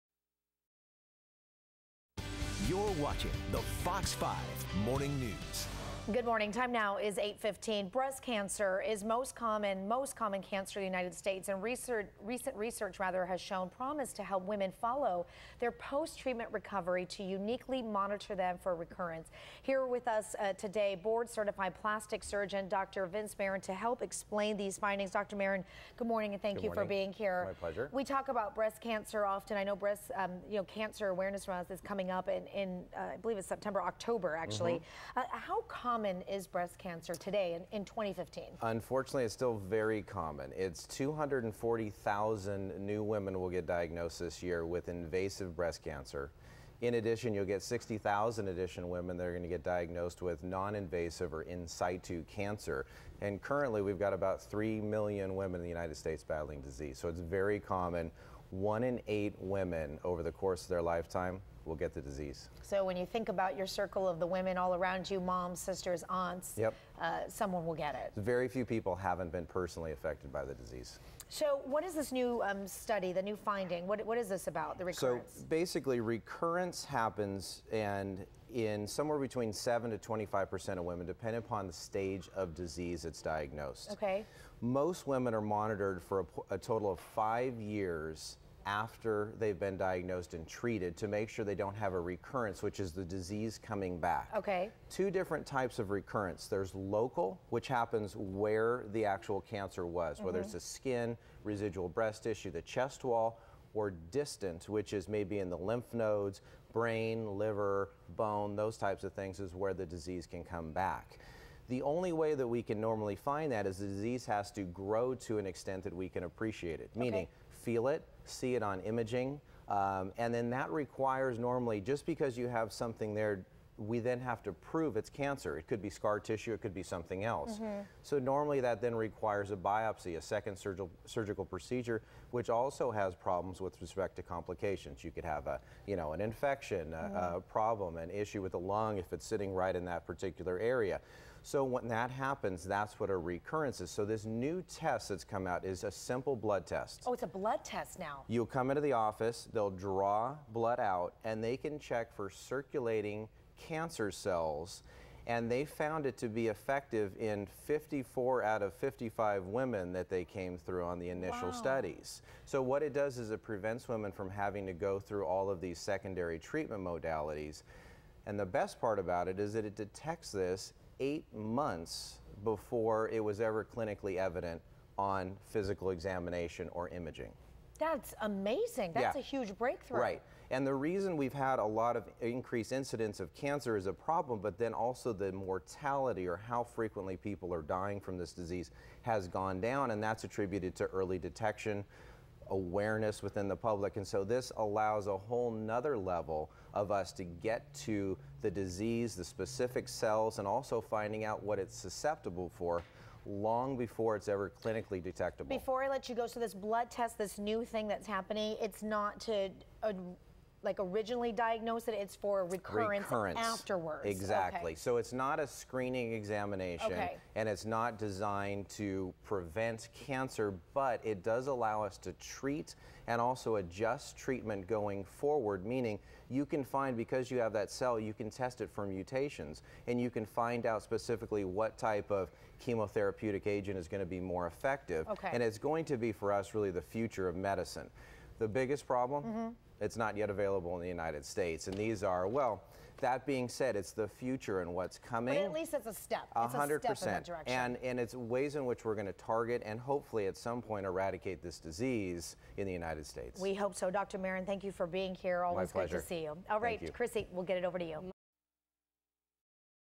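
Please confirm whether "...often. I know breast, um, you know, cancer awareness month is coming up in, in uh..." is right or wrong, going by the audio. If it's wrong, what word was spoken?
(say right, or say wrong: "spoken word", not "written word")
right.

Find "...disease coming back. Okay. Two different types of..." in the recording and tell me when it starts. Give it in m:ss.
1:33.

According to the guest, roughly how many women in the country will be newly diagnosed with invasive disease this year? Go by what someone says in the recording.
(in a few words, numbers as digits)
240,000.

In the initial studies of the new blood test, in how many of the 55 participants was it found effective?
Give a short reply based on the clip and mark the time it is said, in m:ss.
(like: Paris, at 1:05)
54, at 2:37.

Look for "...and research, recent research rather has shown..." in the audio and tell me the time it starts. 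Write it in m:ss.
0:11.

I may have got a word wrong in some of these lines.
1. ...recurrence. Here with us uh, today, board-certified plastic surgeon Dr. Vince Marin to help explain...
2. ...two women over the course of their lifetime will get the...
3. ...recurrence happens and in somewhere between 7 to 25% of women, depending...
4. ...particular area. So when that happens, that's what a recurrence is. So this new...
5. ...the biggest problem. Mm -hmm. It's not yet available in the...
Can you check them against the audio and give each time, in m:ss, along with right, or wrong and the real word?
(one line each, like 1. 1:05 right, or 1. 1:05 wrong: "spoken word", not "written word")
1. 0:18 right
2. 0:59 wrong: "eight", not "two"
3. 1:15 right
4. 2:20 right
5. 3:58 right.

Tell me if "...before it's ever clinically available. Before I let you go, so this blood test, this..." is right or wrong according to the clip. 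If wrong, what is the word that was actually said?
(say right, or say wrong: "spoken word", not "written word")
wrong: "detectable", not "available".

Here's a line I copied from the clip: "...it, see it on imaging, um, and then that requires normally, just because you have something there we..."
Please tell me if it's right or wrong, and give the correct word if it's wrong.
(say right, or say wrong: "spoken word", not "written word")
right.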